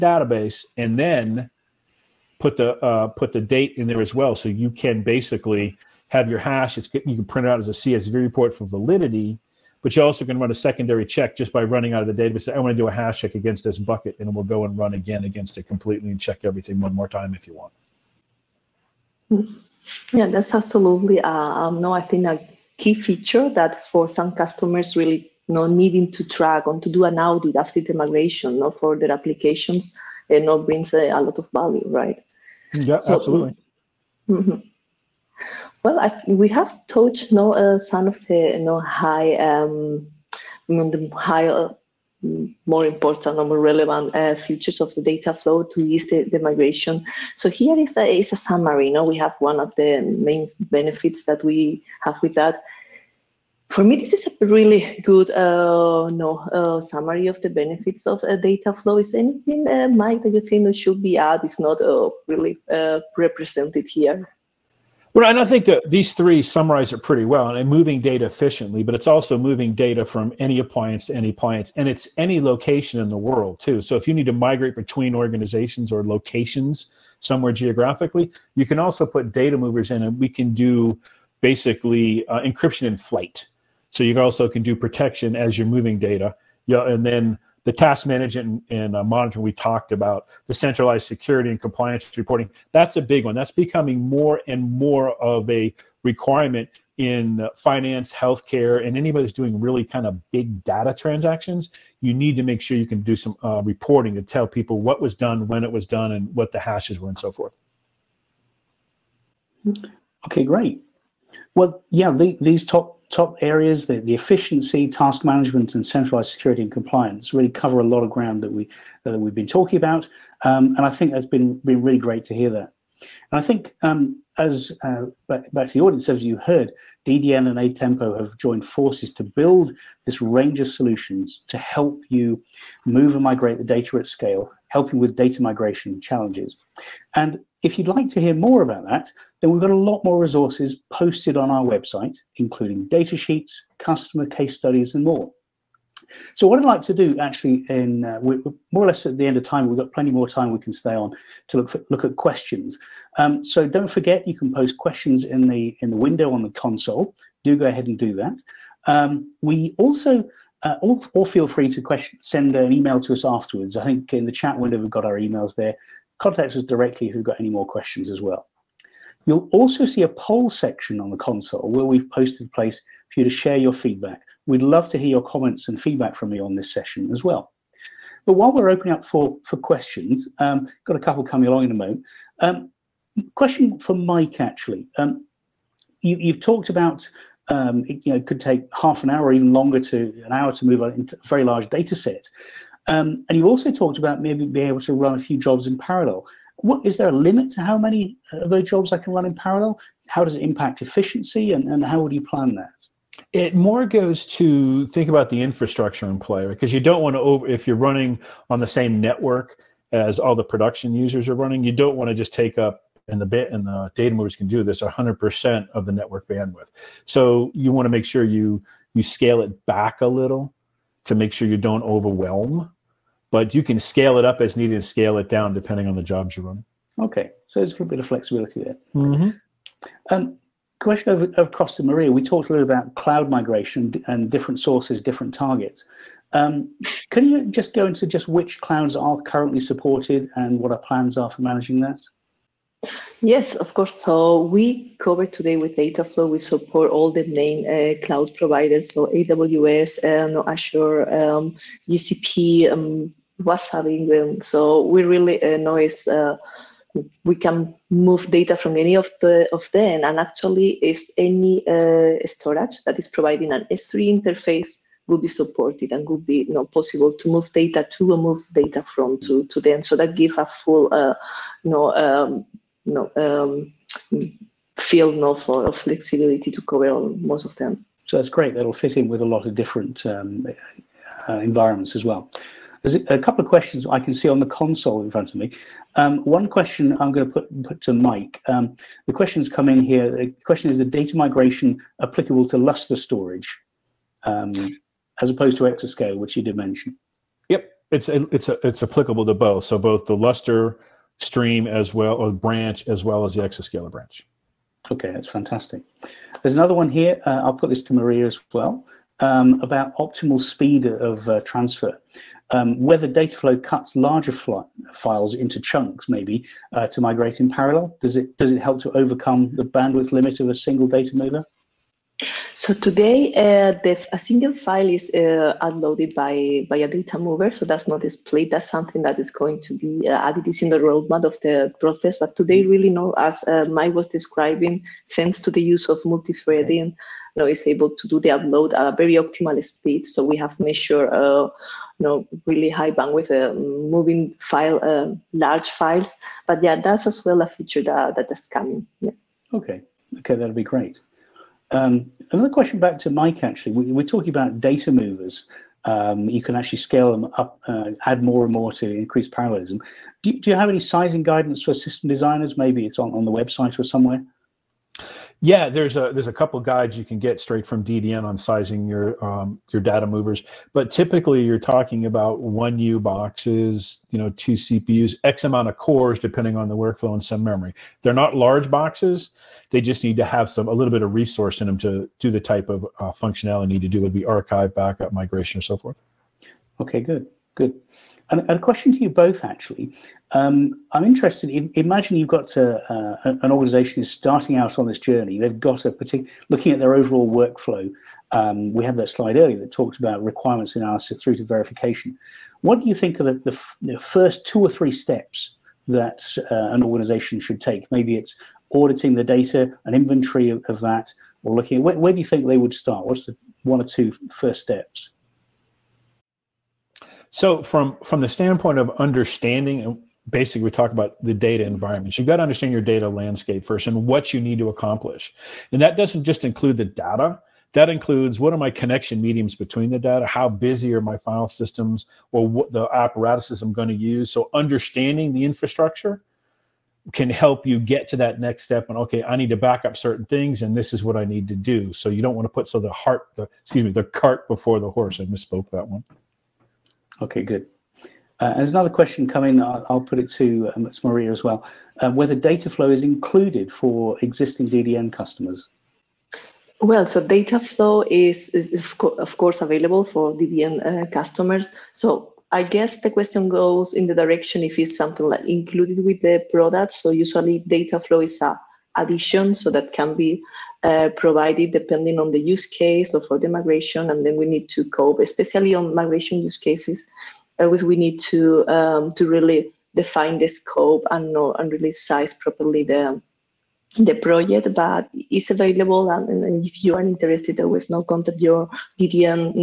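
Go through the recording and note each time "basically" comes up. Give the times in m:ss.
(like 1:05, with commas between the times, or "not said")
0:05, 1:21, 7:00.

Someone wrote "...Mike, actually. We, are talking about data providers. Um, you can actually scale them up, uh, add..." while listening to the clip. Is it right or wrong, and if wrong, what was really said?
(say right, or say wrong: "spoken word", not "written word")
wrong: "movers", not "providers".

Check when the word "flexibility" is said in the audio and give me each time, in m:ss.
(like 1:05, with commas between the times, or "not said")
3:48, 4:35.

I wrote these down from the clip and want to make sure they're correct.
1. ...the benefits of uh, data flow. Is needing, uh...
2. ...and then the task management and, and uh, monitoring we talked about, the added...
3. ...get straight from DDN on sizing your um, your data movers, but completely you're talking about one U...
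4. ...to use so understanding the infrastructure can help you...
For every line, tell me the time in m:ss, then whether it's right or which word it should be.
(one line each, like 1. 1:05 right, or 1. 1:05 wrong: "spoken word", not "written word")
1. 0:57 wrong: "anything", not "needing"
2. 1:26 wrong: "centralized", not "added"
3. 6:07 wrong: "typically", not "completely"
4. 7:13 right.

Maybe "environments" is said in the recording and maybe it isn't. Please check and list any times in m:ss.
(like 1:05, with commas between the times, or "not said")
4:41, 7:01.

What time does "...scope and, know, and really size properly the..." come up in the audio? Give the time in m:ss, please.
8:00.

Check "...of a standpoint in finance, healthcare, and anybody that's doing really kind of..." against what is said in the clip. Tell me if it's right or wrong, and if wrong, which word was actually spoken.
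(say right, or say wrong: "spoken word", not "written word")
wrong: "requirement", not "standpoint".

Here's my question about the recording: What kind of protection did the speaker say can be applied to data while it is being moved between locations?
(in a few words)
encryption in flight.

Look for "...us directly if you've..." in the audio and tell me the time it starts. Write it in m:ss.
2:46.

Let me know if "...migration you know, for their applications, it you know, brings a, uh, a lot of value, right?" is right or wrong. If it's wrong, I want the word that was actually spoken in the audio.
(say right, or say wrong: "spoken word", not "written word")
right.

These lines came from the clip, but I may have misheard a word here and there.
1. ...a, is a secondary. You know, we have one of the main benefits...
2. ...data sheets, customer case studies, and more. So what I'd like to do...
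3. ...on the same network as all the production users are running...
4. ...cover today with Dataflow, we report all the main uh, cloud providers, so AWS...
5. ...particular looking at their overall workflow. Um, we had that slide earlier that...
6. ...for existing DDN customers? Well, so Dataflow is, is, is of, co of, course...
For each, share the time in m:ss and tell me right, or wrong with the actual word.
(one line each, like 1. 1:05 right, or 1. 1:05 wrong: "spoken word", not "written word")
1. 0:47 wrong: "summary", not "secondary"
2. 2:22 right
3. 3:28 right
4. 4:04 wrong: "support", not "report"
5. 6:35 right
6. 7:33 right.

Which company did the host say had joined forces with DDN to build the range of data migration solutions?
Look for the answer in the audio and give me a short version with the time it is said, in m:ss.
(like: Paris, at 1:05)
Atempo, at 2:07.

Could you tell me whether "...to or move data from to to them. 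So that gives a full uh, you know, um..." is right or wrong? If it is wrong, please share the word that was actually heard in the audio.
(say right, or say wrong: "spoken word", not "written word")
right.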